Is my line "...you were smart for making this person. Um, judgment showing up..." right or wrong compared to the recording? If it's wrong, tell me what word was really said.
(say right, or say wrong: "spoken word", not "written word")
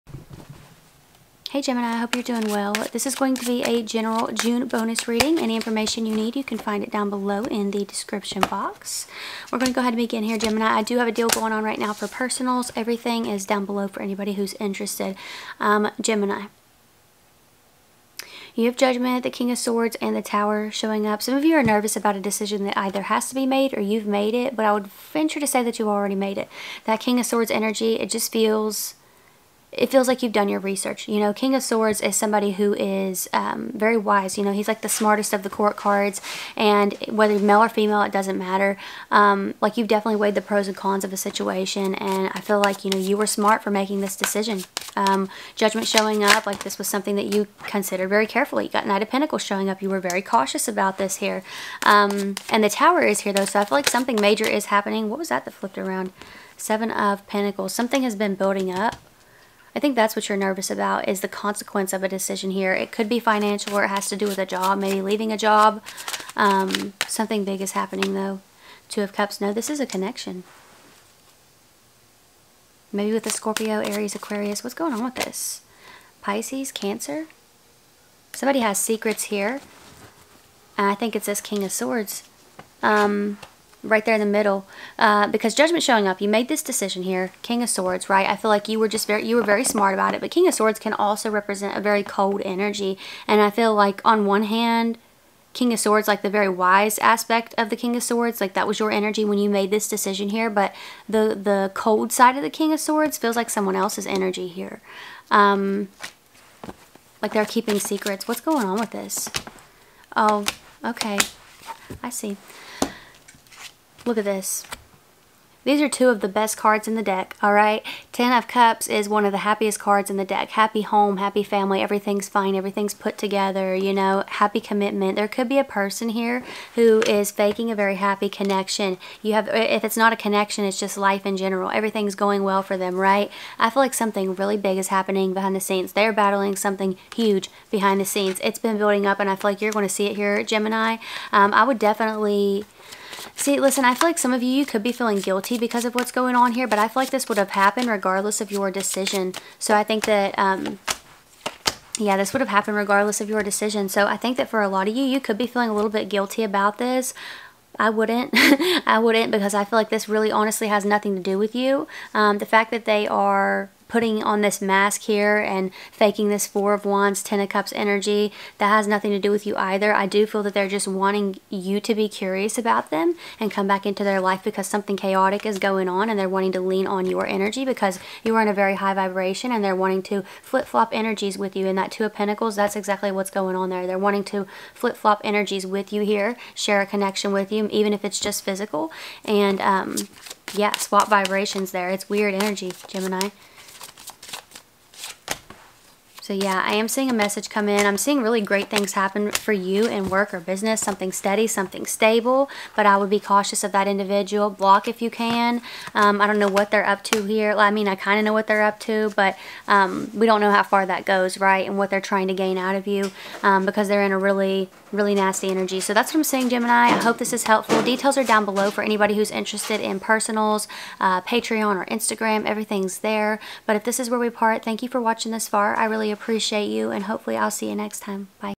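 wrong: "decision", not "person".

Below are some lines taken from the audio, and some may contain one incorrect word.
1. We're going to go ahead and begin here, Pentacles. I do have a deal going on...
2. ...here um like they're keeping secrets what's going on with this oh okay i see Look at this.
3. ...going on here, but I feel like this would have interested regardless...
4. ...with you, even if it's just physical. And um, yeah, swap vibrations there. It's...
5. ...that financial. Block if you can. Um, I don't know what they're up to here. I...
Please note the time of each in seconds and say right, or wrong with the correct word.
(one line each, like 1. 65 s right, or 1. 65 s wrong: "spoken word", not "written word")
1. 9 s wrong: "Gemini", not "Pentacles"
2. 104 s right
3. 146 s wrong: "happened", not "interested"
4. 187 s right
5. 203 s wrong: "individual", not "financial".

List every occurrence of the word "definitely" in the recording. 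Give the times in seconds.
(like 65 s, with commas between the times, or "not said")
39 s, 141 s.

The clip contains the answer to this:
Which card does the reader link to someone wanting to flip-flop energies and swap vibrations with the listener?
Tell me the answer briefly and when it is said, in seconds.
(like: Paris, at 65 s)
Two of Pentacles, at 181 s.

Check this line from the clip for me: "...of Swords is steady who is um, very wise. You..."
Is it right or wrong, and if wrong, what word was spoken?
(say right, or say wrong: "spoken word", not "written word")
wrong: "somebody", not "steady".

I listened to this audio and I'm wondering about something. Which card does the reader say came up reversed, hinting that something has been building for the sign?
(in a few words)
Seven of Pentacles.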